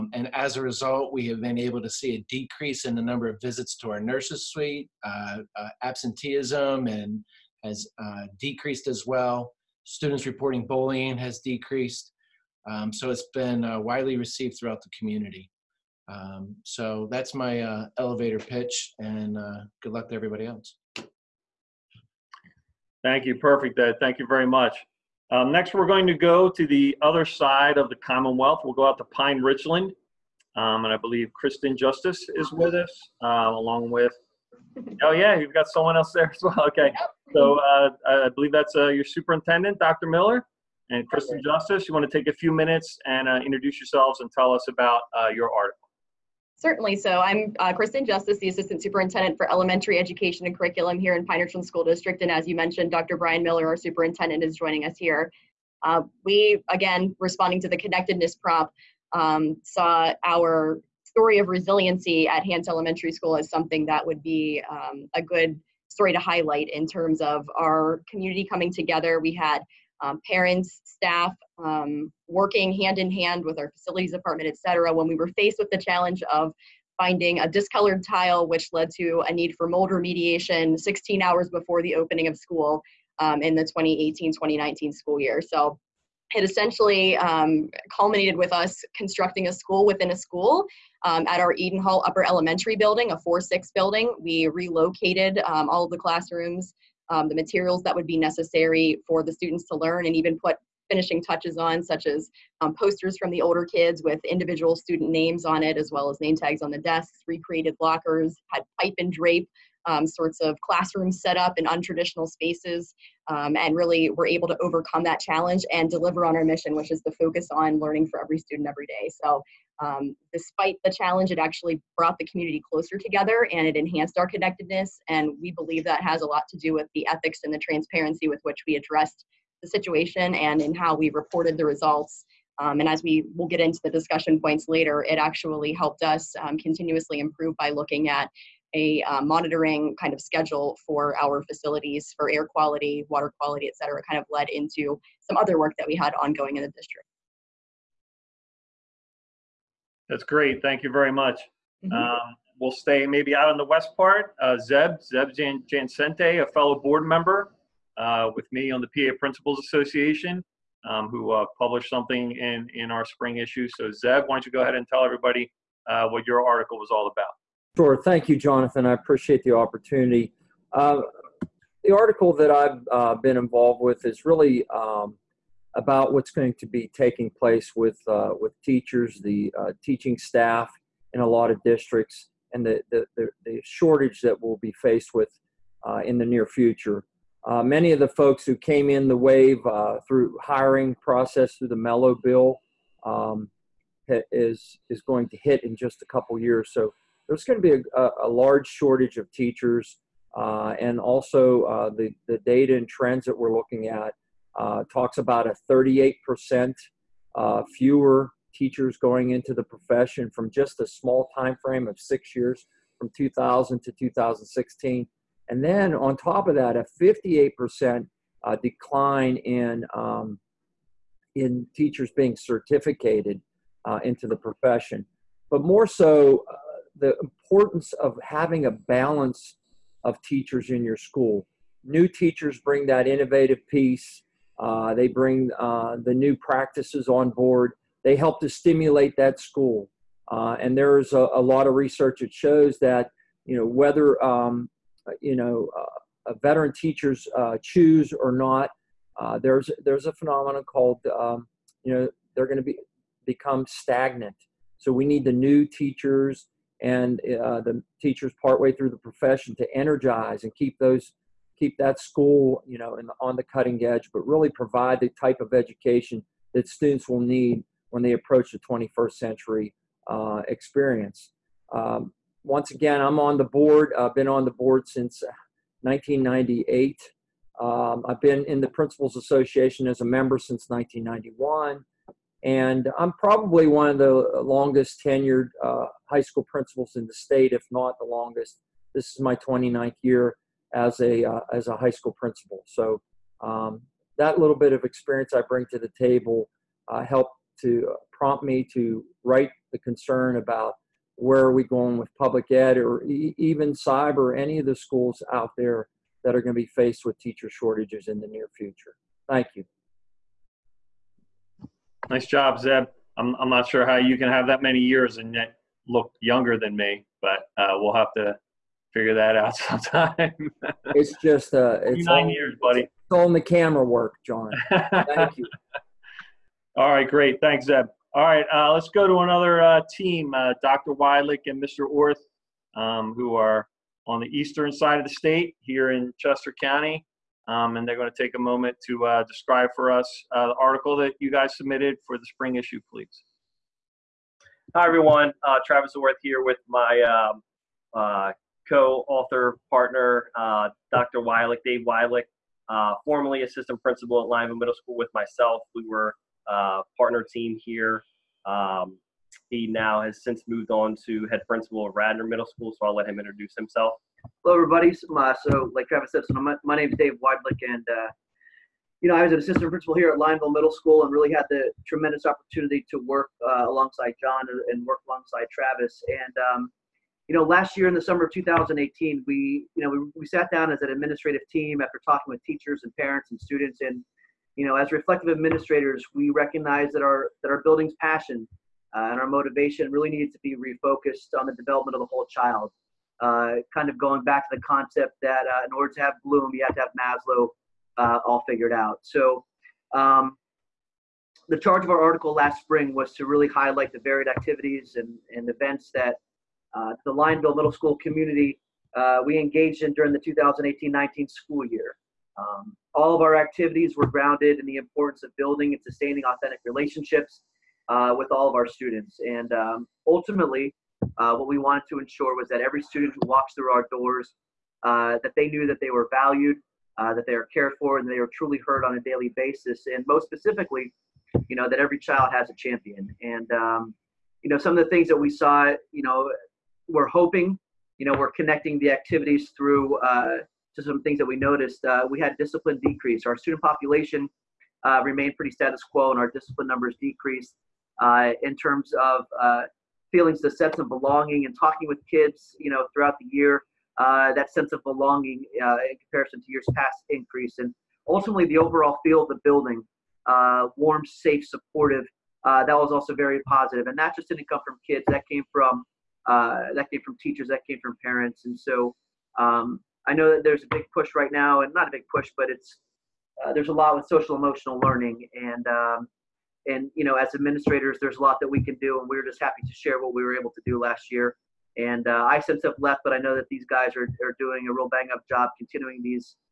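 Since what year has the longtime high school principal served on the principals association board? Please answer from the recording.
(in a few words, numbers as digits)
1998.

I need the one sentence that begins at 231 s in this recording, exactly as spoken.
New teachers bring that innovative piece.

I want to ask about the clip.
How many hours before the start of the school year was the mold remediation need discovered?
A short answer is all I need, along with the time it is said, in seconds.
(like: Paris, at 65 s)
16, at 80 s.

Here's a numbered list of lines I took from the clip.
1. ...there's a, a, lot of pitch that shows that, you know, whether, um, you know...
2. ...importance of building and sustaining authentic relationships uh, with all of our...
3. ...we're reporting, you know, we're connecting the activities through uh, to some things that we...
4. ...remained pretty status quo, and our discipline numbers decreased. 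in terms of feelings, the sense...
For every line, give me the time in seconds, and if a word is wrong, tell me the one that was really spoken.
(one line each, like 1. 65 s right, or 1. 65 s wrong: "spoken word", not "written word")
1. 240 s wrong: "research", not "pitch"
2. 414 s right
3. 436 s wrong: "hoping", not "reporting"
4. 445 s right.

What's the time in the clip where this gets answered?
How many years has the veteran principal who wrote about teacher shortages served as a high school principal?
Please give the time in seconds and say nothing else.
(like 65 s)
289 s.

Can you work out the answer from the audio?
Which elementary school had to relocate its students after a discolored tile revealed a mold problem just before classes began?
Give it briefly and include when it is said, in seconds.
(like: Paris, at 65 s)
Hance Elementary School, at 62 s.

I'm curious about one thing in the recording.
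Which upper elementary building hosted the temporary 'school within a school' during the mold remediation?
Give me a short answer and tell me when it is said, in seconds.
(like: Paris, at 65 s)
Eden Hall, at 91 s.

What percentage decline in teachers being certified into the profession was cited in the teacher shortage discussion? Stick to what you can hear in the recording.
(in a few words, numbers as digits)
58%.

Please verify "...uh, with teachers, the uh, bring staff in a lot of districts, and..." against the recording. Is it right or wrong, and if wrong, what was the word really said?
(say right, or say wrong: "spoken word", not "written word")
wrong: "teaching", not "bring".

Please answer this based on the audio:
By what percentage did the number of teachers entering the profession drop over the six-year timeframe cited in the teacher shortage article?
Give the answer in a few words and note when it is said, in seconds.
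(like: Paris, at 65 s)
38%, at 205 s.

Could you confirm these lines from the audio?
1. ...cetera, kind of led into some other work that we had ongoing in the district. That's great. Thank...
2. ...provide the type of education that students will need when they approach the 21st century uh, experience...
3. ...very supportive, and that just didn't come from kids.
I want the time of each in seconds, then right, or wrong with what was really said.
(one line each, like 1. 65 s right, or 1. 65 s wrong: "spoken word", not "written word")
1. 143 s right
2. 264 s right
3. 463 s wrong: "positive", not "supportive".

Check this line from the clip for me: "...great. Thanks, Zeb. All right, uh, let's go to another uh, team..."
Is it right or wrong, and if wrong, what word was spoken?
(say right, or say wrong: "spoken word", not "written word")
right.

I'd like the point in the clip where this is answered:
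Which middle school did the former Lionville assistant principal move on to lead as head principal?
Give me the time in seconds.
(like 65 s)
361 s.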